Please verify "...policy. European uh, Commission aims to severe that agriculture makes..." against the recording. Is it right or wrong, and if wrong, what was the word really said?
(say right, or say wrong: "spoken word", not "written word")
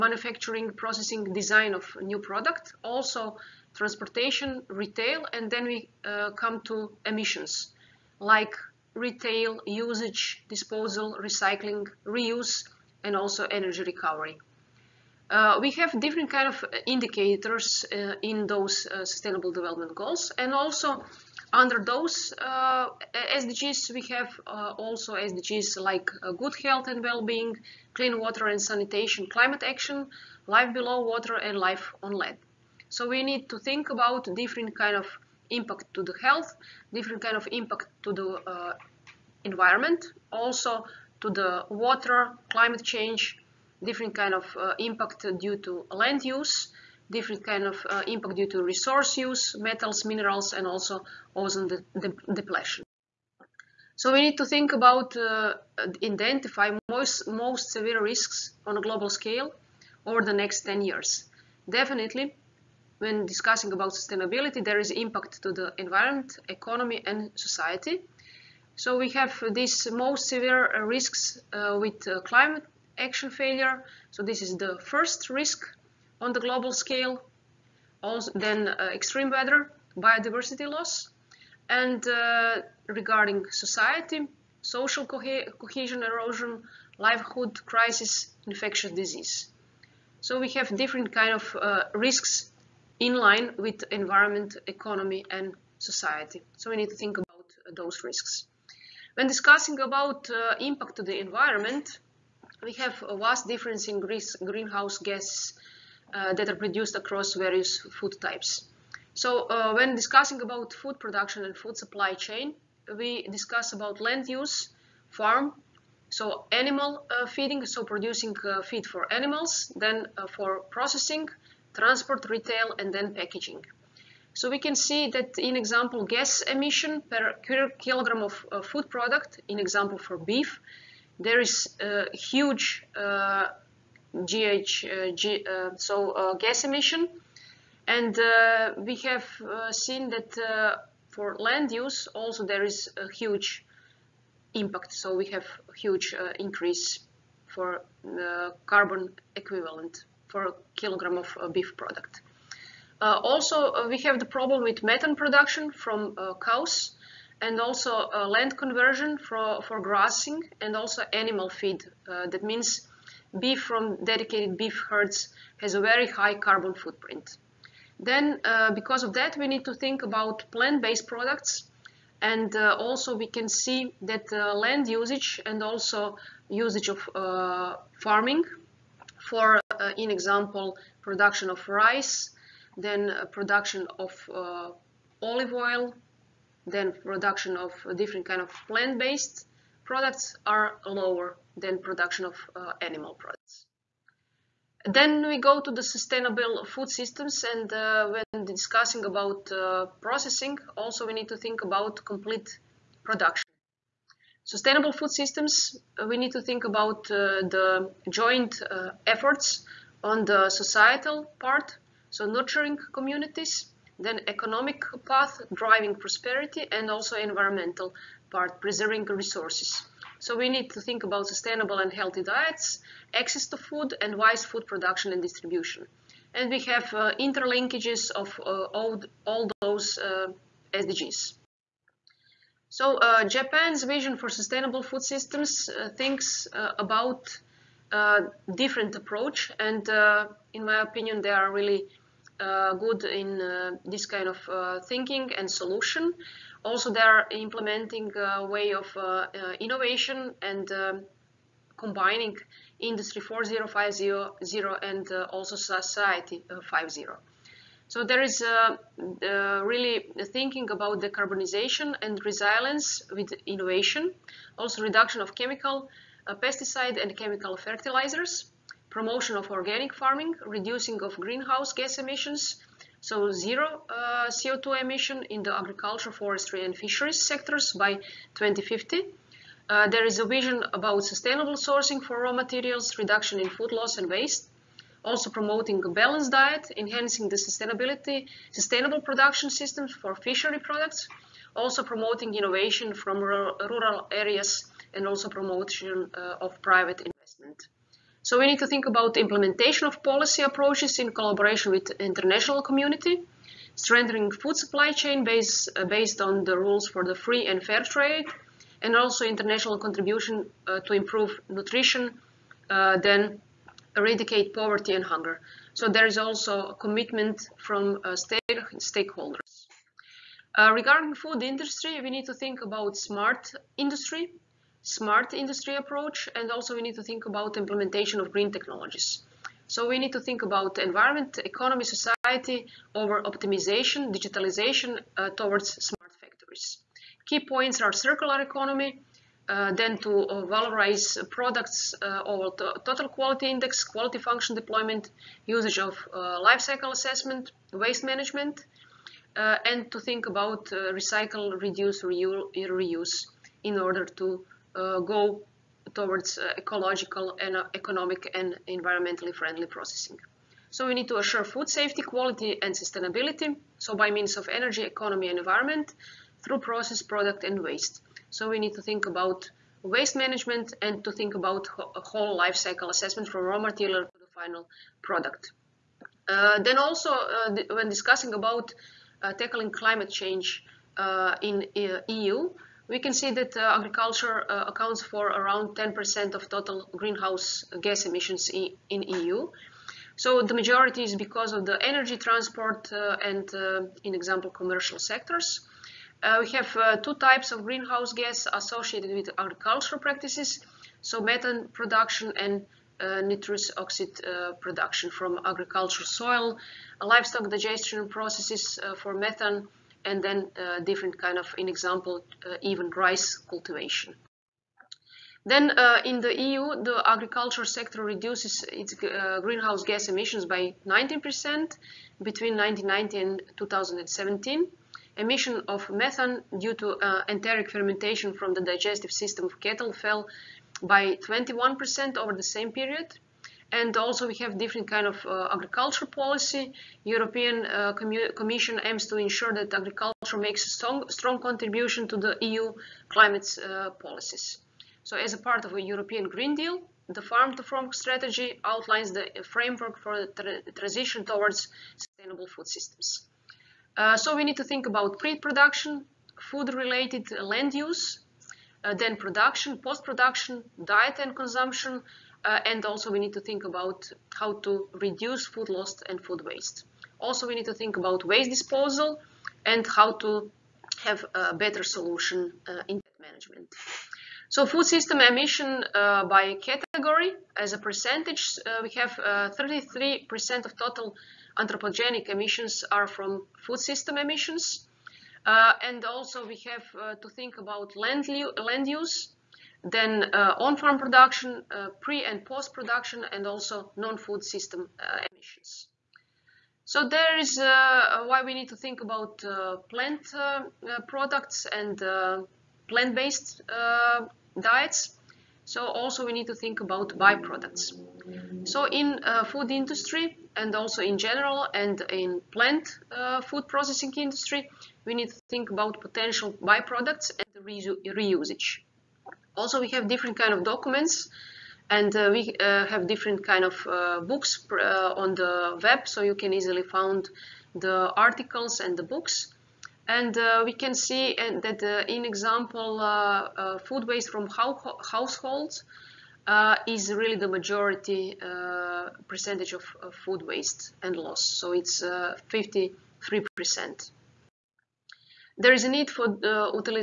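wrong: "ensure", not "severe".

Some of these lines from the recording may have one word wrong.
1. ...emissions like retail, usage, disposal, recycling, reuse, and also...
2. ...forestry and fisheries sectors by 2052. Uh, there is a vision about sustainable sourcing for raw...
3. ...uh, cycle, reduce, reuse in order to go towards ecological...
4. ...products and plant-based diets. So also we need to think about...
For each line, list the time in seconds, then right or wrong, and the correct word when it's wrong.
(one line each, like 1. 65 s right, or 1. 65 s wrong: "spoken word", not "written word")
1. 7 s right
2. 276 s wrong: "2050", not "2052"
3. 350 s wrong: "recycle", not "cycle"
4. 501 s right.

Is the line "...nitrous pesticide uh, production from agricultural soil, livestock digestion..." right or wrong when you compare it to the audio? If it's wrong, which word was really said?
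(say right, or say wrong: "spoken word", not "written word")
wrong: "oxide", not "pesticide".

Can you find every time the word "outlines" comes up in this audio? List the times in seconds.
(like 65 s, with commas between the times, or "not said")
448 s.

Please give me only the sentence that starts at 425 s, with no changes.
Emission of methane due to uh, enteric fermentation from the digestive system of cattle fell by 21% over the same period.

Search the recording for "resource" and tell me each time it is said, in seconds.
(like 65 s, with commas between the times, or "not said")
48 s, 219 s.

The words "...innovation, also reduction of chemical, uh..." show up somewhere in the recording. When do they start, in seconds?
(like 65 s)
263 s.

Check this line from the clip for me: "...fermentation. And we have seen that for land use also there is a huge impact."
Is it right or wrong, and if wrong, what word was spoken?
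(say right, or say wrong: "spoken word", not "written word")
wrong: "emission", not "fermentation".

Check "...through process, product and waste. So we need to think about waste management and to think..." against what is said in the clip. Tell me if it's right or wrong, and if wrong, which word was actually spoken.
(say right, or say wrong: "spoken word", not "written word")
right.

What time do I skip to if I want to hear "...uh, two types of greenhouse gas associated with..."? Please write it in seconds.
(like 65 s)
396 s.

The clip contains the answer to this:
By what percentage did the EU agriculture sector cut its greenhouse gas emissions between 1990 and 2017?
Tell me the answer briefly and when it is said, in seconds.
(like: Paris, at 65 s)
19%, at 420 s.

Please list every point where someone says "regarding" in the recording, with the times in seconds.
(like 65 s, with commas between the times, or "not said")
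82 s, 320 s.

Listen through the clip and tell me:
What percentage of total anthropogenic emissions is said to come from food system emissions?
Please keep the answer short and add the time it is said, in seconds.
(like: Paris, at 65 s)
33%, at 479 s.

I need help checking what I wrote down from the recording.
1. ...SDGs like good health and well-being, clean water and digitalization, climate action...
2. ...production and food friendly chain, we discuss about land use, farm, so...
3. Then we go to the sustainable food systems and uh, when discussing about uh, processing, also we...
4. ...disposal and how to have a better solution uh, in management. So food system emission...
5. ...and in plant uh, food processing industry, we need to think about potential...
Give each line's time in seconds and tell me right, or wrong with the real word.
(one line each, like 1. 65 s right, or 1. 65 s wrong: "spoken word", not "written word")
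1. 25 s wrong: "sanitation", not "digitalization"
2. 110 s wrong: "supply", not "friendly"
3. 194 s right
4. 468 s right
5. 511 s right.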